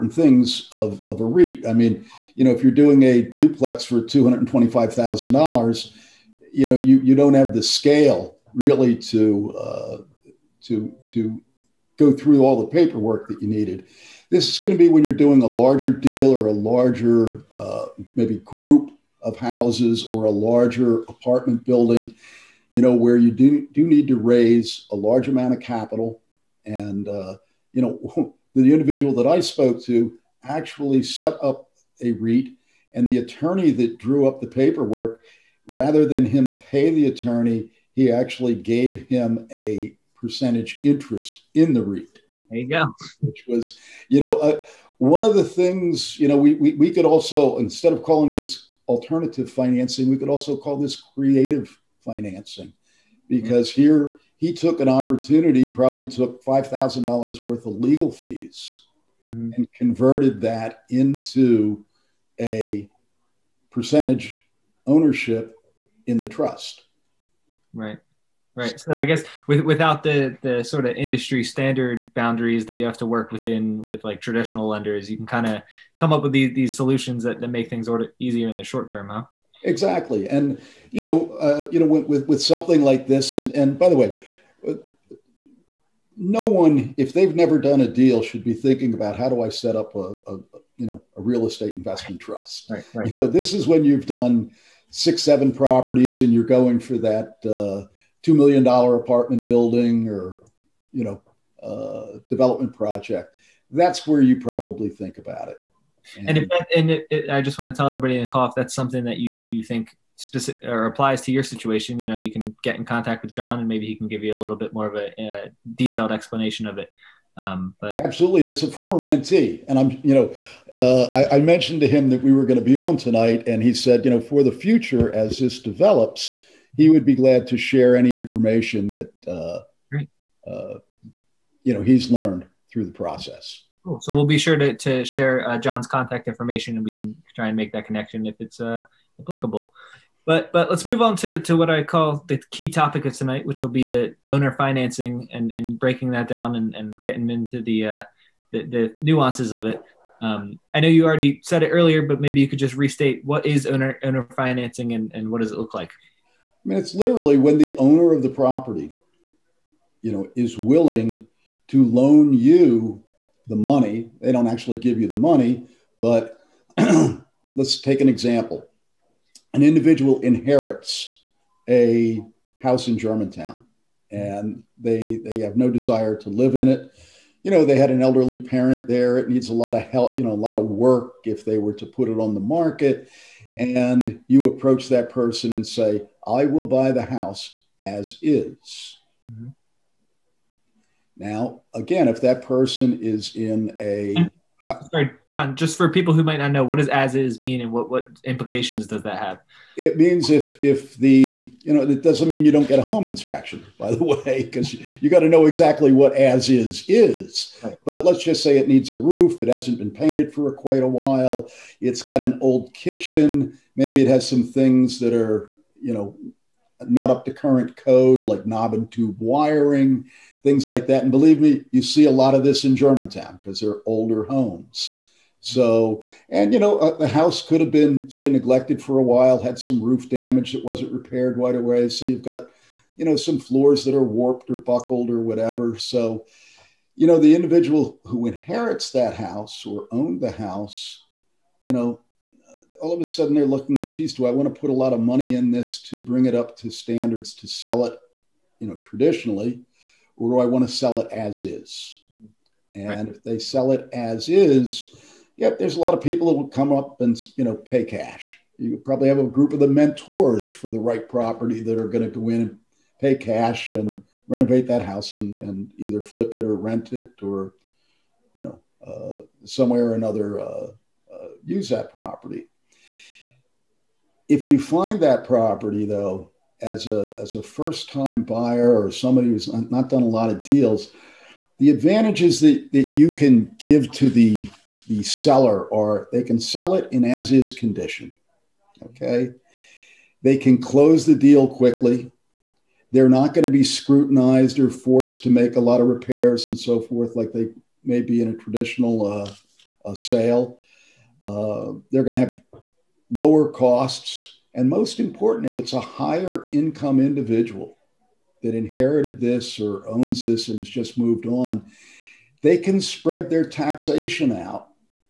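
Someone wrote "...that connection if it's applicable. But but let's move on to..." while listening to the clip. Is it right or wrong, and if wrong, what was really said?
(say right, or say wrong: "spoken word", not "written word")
right.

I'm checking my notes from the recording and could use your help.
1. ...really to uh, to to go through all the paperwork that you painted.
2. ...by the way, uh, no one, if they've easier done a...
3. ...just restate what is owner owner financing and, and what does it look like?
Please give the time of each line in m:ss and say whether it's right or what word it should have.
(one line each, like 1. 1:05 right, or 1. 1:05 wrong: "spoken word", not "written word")
1. 0:08 wrong: "needed", not "painted"
2. 1:23 wrong: "never", not "easier"
3. 2:32 right.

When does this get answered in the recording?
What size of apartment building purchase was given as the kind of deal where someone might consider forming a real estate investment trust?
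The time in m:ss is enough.
1:38.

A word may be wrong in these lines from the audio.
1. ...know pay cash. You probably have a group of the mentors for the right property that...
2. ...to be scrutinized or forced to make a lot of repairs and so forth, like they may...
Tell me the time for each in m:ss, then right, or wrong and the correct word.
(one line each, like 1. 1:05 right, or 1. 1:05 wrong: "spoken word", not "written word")
1. 4:17 right
2. 4:53 right.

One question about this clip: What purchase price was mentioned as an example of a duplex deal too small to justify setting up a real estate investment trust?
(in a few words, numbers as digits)
$225,000.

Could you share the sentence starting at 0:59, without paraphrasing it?
and converted that into a percentage ownership in the trust.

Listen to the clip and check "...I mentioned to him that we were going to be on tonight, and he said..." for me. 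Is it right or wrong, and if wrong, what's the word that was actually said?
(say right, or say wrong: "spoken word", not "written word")
right.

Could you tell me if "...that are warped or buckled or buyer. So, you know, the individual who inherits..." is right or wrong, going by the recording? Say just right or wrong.
wrong.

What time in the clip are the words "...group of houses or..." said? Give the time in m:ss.
0:18.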